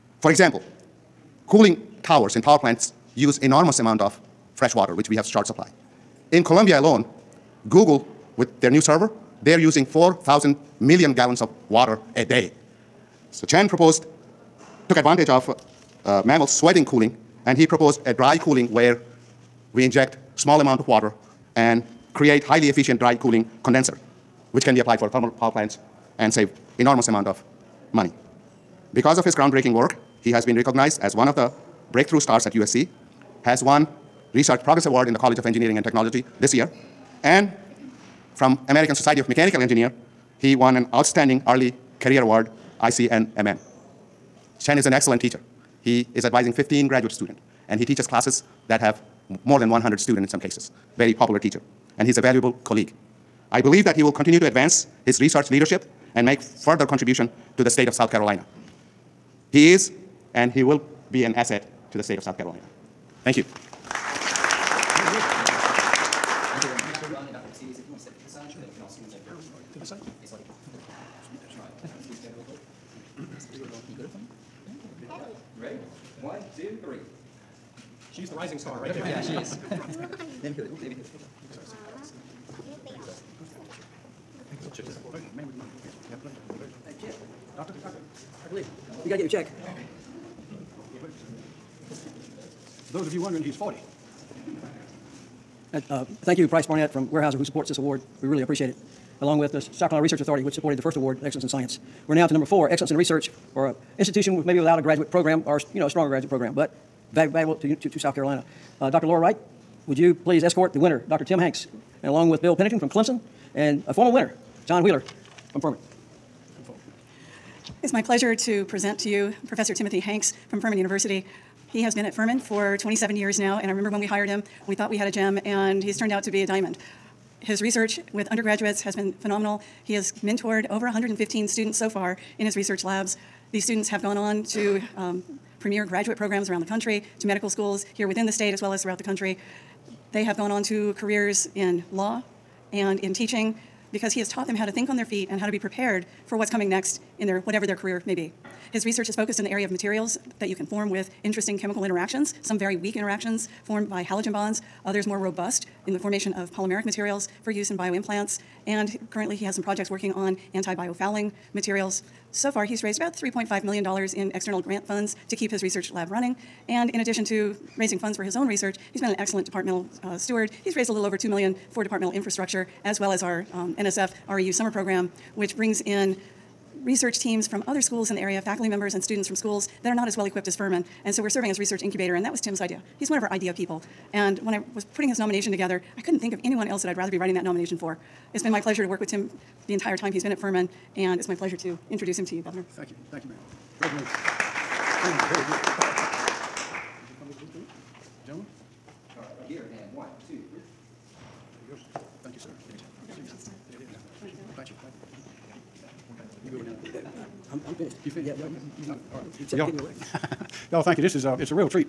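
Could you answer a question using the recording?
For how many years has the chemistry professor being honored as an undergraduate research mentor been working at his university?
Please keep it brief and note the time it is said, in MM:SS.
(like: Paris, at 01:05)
27, at 02:02.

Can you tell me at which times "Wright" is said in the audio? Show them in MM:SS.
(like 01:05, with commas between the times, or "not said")
01:49.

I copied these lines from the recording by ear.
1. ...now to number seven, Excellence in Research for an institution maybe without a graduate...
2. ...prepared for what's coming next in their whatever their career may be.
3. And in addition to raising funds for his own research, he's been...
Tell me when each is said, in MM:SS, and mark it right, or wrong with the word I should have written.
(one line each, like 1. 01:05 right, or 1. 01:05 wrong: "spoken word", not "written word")
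1. 01:42 wrong: "four", not "seven"
2. 02:25 right
3. 02:46 right.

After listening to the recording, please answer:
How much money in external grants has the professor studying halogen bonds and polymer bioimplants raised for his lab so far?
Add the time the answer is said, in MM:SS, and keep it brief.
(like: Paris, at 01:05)
$3.5 million, at 02:43.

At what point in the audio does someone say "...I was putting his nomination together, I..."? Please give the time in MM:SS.
03:04.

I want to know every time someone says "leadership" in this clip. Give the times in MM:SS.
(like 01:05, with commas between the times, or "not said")
00:55.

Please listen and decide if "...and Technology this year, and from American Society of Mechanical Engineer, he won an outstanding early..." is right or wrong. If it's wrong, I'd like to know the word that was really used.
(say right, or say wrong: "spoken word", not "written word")
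right.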